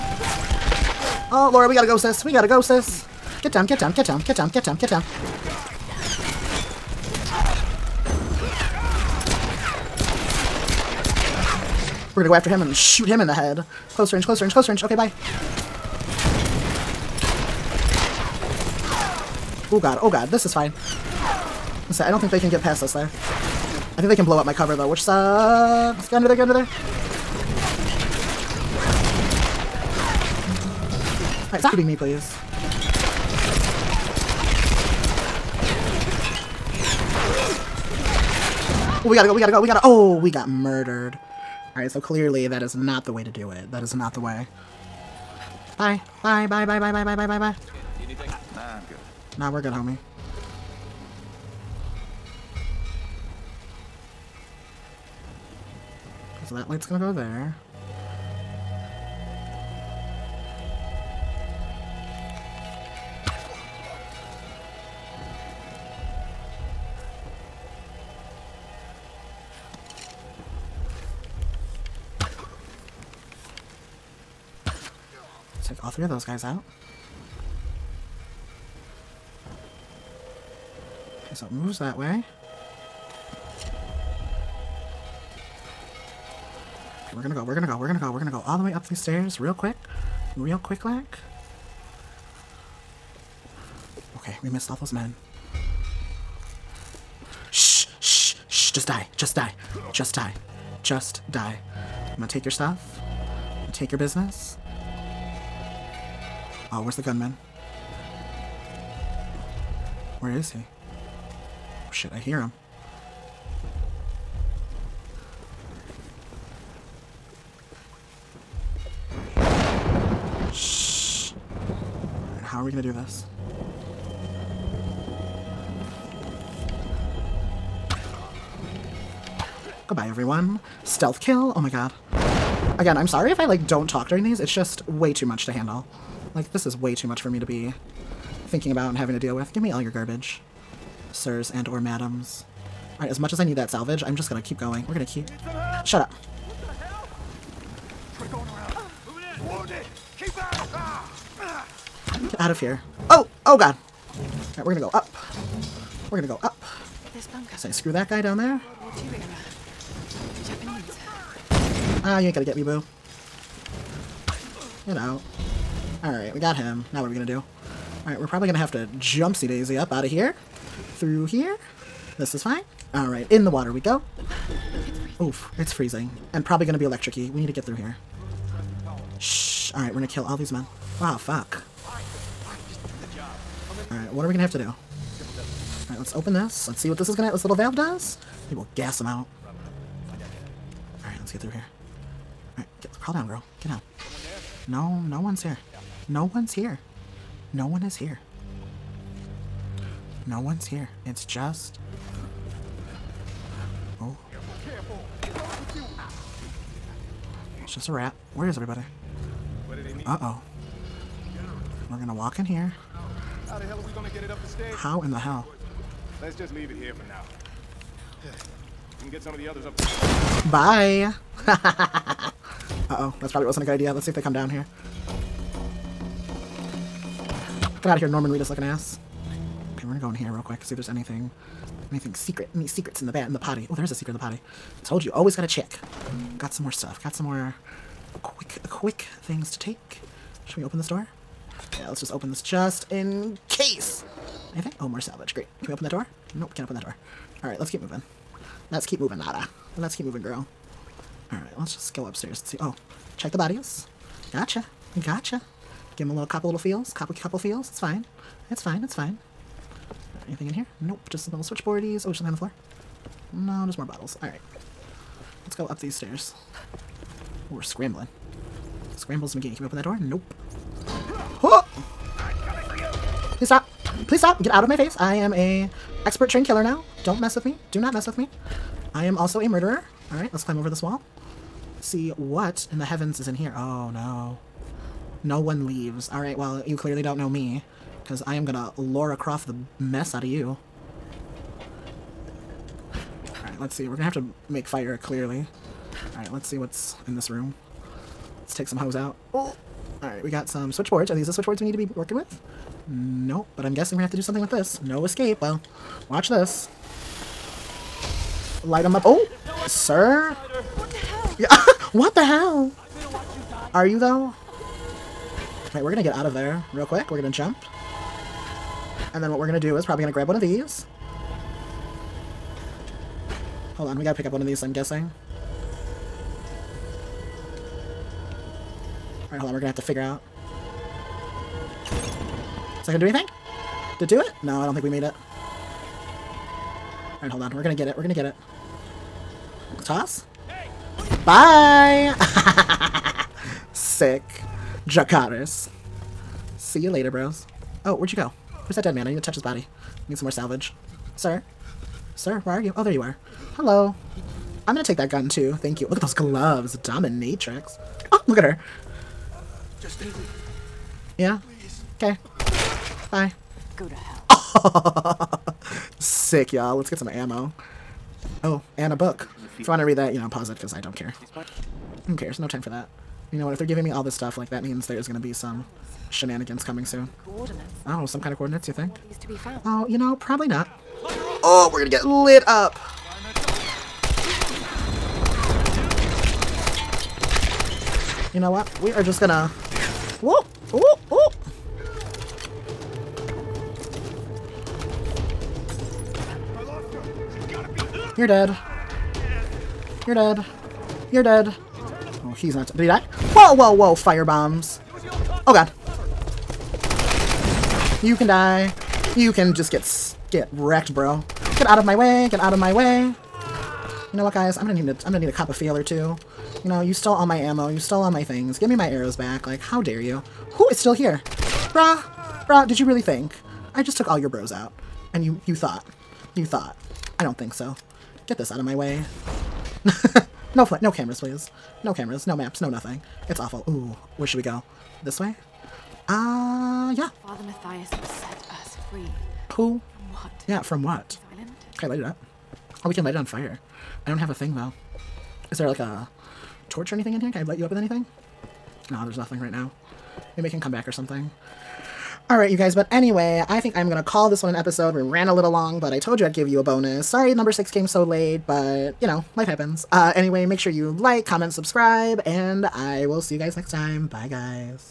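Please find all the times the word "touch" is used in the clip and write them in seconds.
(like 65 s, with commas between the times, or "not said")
349 s.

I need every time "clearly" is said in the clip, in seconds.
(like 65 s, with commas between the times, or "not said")
41 s, 286 s, 294 s.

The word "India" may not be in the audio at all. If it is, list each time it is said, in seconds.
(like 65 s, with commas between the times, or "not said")
not said.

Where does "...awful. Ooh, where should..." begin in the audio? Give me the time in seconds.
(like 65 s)
433 s.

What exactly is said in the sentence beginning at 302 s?
Nope, but I'm guessing we have to do something with this.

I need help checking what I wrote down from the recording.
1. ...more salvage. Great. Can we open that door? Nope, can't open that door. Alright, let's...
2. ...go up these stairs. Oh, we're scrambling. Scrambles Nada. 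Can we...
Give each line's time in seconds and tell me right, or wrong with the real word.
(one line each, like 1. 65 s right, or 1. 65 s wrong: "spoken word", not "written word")
1. 244 s right
2. 265 s wrong: "McGee", not "Nada".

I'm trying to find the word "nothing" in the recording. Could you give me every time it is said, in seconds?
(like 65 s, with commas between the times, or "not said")
432 s, 449 s.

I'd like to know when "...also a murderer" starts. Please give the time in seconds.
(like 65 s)
279 s.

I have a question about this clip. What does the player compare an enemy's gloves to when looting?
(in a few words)
Dominatrix.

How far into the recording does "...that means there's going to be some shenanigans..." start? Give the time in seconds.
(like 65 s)
374 s.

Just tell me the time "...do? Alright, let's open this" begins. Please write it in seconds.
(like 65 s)
184 s.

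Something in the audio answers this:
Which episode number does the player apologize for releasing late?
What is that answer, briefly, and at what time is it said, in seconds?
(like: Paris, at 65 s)
6, at 457 s.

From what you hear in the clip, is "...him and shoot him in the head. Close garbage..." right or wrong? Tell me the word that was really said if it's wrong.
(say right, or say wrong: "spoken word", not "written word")
wrong: "range", not "garbage".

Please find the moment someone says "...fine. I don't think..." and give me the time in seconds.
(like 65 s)
20 s.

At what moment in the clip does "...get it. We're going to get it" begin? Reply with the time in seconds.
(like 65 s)
337 s.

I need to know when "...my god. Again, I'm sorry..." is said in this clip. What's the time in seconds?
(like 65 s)
131 s.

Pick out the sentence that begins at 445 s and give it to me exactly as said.
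Is there, like, a torch or anything in here?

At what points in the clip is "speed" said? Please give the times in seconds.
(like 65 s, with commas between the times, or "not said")
not said.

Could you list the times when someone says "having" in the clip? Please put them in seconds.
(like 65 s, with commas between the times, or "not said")
138 s.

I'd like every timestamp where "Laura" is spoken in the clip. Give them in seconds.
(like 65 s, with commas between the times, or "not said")
1 s, 288 s.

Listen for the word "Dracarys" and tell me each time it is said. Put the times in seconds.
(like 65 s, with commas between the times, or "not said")
344 s.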